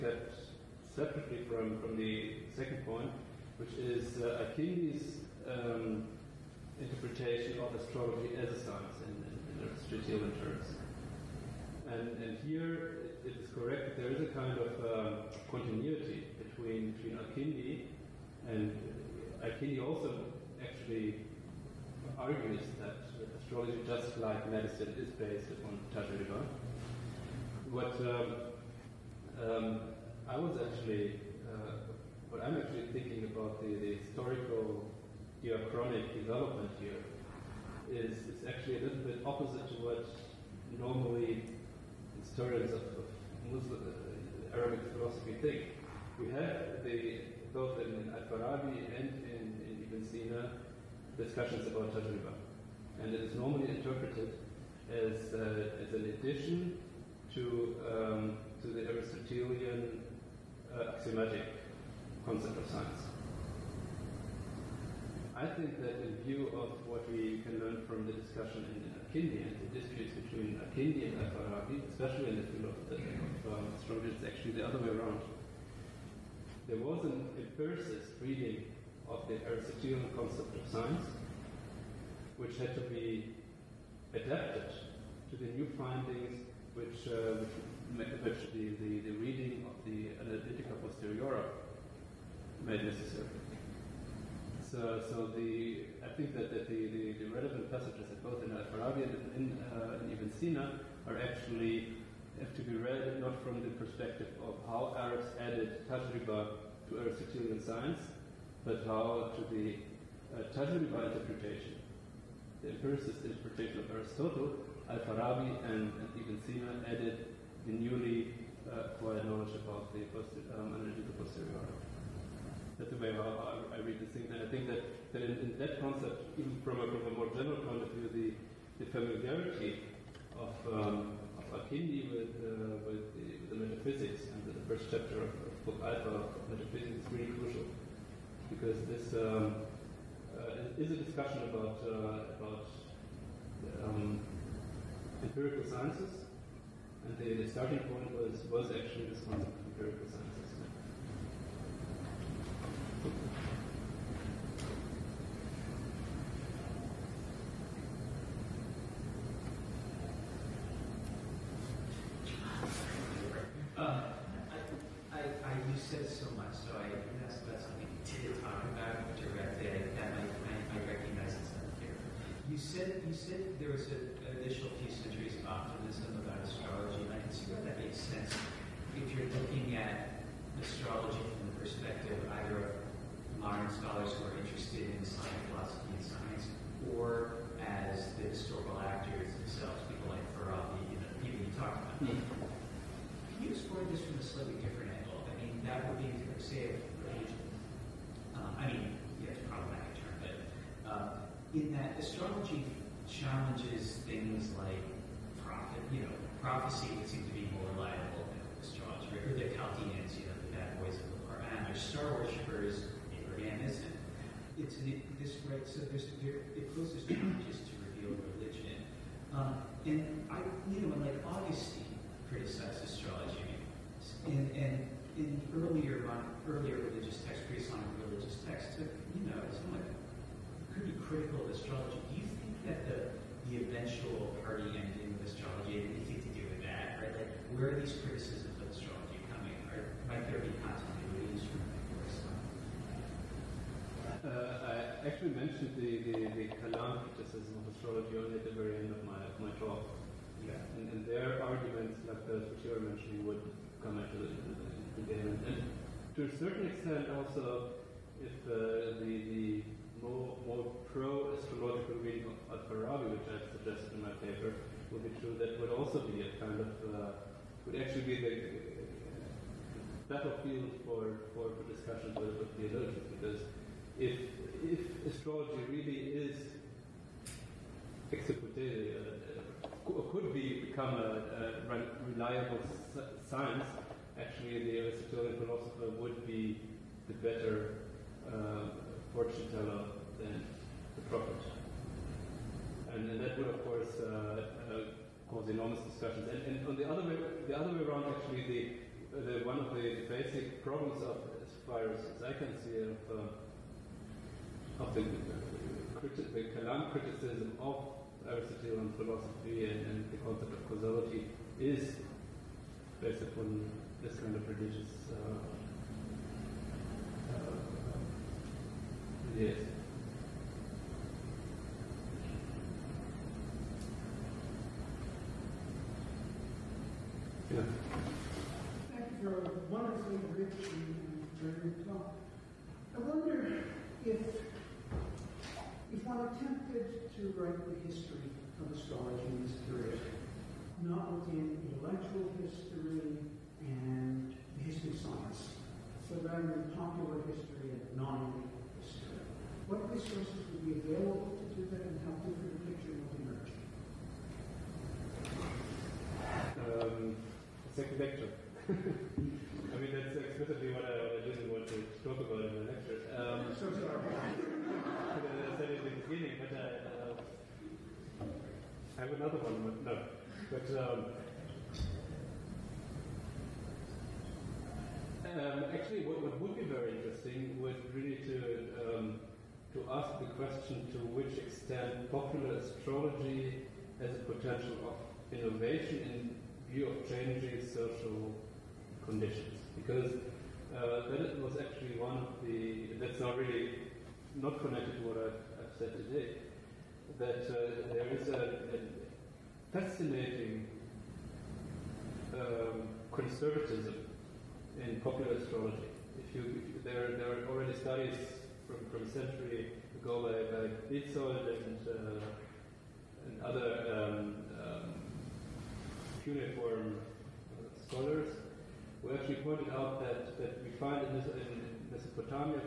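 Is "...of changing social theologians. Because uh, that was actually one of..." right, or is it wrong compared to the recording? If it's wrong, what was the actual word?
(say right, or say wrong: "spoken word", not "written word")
wrong: "conditions", not "theologians".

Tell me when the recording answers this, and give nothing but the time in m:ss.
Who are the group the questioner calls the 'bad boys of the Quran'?
3:29.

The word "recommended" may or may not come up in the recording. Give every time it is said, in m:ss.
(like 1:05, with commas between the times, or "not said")
not said.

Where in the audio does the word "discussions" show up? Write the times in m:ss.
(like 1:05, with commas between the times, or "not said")
0:51, 1:08, 2:20, 4:55.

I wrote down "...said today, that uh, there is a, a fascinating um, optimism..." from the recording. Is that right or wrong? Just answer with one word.
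wrong.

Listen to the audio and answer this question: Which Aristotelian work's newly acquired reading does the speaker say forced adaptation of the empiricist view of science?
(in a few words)
Analytica Posteriora.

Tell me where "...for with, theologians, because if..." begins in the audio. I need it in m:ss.
4:31.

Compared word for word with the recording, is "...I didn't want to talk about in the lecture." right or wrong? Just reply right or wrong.
right.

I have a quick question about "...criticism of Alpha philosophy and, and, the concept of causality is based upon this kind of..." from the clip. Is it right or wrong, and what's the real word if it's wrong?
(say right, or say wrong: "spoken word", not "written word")
wrong: "Aristotelian", not "Alpha".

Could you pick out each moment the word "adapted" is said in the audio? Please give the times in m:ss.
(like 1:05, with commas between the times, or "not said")
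1:24.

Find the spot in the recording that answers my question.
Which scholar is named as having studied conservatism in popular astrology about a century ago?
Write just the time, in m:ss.
6:50.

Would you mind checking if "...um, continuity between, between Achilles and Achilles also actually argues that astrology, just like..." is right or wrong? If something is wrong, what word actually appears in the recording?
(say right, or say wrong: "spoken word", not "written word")
right.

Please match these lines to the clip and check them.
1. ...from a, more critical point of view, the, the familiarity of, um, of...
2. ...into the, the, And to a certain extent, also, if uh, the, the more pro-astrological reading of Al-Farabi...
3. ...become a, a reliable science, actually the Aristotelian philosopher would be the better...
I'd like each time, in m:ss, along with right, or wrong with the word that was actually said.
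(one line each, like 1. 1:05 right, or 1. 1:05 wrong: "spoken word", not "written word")
1. 2:06 wrong: "general", not "critical"
2. 4:13 right
3. 4:40 right.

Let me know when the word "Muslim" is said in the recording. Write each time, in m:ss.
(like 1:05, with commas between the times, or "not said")
0:43.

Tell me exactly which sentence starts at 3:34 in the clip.
It's an, this right, so there's there, it poses challenges to reveal religion.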